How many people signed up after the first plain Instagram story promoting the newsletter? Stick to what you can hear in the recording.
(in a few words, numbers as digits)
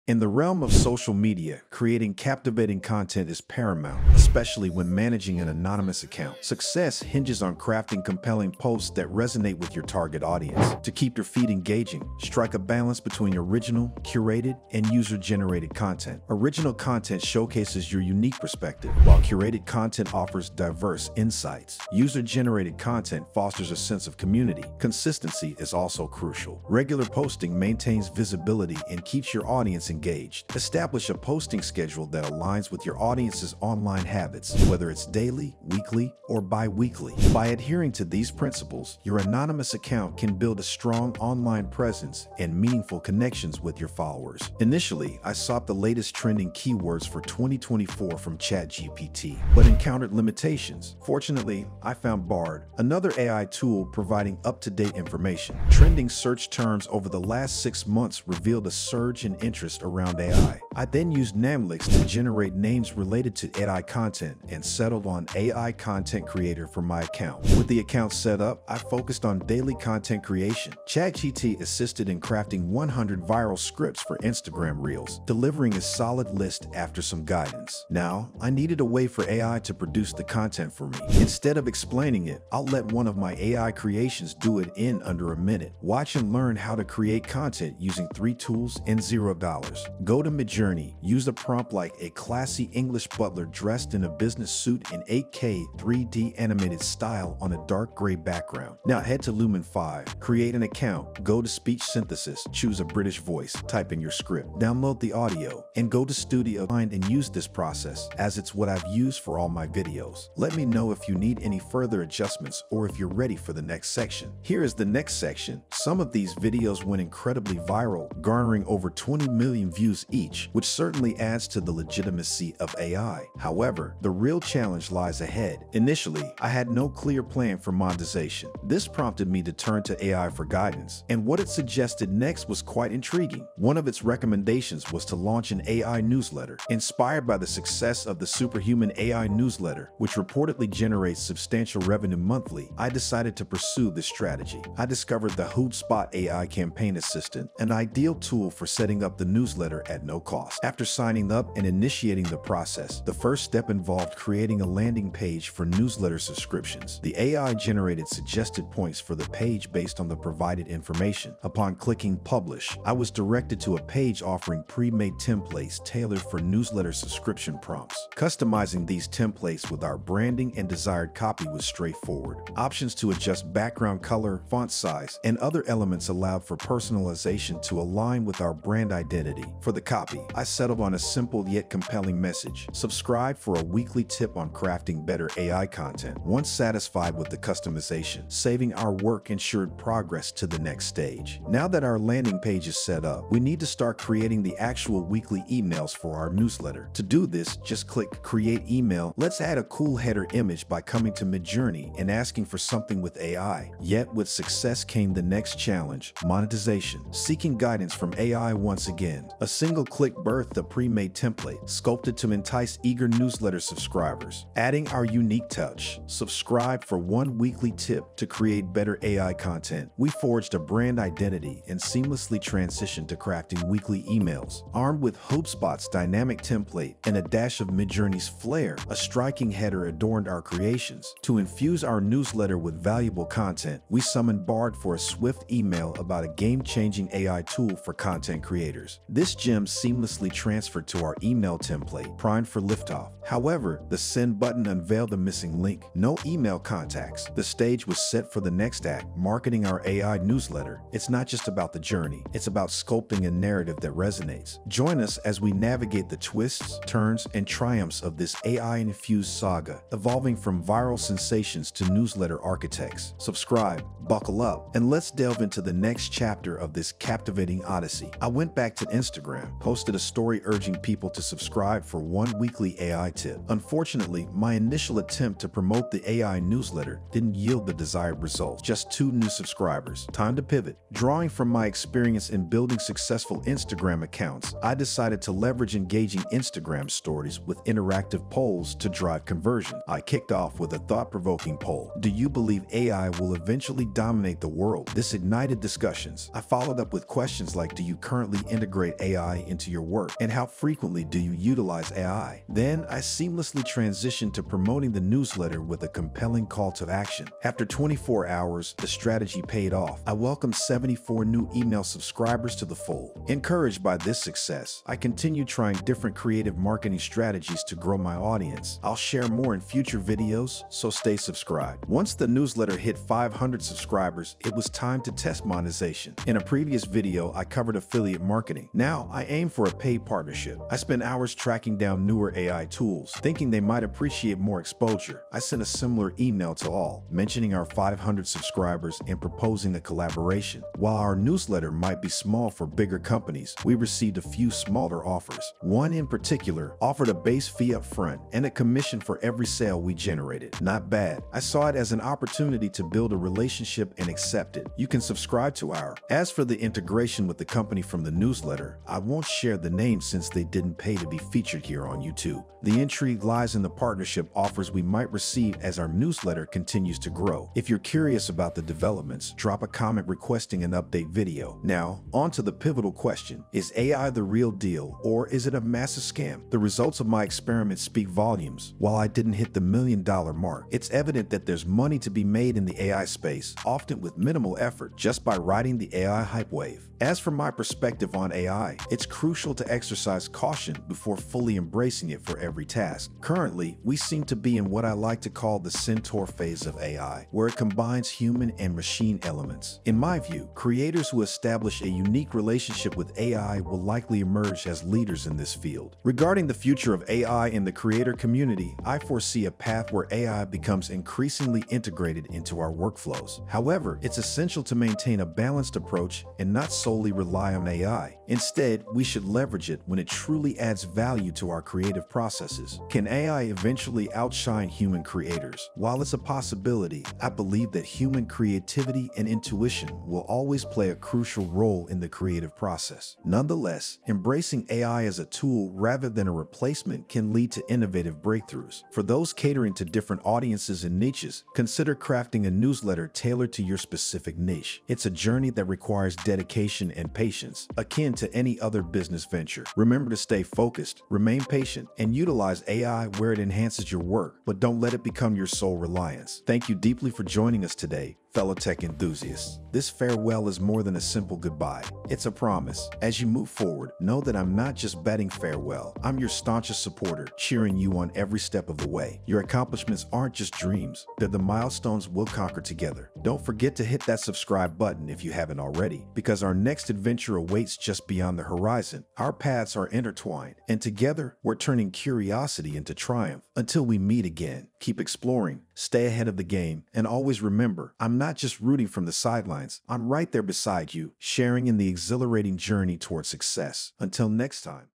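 2.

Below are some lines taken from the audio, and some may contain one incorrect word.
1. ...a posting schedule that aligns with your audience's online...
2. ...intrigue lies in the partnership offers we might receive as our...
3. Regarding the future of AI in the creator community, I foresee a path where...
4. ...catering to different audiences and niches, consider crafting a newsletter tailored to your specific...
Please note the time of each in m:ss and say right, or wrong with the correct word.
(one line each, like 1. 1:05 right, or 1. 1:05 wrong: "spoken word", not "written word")
1. 0:31 right
2. 6:02 right
3. 6:46 right
4. 7:19 right.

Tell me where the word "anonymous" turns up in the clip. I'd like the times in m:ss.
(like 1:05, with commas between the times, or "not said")
0:05, 0:39.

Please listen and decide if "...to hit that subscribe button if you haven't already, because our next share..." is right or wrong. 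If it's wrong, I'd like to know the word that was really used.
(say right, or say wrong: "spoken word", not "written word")
wrong: "adventure", not "share".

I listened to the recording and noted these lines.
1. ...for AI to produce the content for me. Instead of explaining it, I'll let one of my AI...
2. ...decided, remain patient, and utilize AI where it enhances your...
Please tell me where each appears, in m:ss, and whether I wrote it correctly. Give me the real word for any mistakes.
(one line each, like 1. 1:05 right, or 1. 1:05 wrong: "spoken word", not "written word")
1. 1:19 right
2. 7:30 wrong: "focused", not "decided".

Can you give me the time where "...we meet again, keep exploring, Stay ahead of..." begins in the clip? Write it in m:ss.
8:03.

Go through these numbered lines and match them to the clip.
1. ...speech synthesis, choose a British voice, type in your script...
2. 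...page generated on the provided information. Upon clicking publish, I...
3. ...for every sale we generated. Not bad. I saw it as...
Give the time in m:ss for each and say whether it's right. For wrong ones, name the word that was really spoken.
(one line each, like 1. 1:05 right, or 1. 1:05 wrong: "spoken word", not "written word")
1. 1:41 right
2. 2:39 wrong: "based", not "generated"
3. 5:48 right.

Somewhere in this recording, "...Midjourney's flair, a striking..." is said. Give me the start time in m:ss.
3:47.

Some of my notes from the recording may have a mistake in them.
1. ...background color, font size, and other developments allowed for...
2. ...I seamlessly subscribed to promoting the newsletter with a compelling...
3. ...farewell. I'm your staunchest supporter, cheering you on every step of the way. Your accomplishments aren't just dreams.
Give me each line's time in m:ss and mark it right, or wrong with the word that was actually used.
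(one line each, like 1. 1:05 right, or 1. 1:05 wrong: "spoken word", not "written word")
1. 2:53 wrong: "elements", not "developments"
2. 5:02 wrong: "transitioned", not "subscribed"
3. 7:45 right.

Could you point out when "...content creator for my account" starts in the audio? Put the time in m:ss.
1:05.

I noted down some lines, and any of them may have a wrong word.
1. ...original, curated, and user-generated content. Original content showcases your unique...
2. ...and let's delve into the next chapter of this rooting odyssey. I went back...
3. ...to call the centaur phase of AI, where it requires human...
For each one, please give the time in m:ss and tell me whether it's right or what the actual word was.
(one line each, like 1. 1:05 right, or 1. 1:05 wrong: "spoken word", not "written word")
1. 0:13 right
2. 4:24 wrong: "captivating", not "rooting"
3. 6:35 wrong: "combines", not "requires".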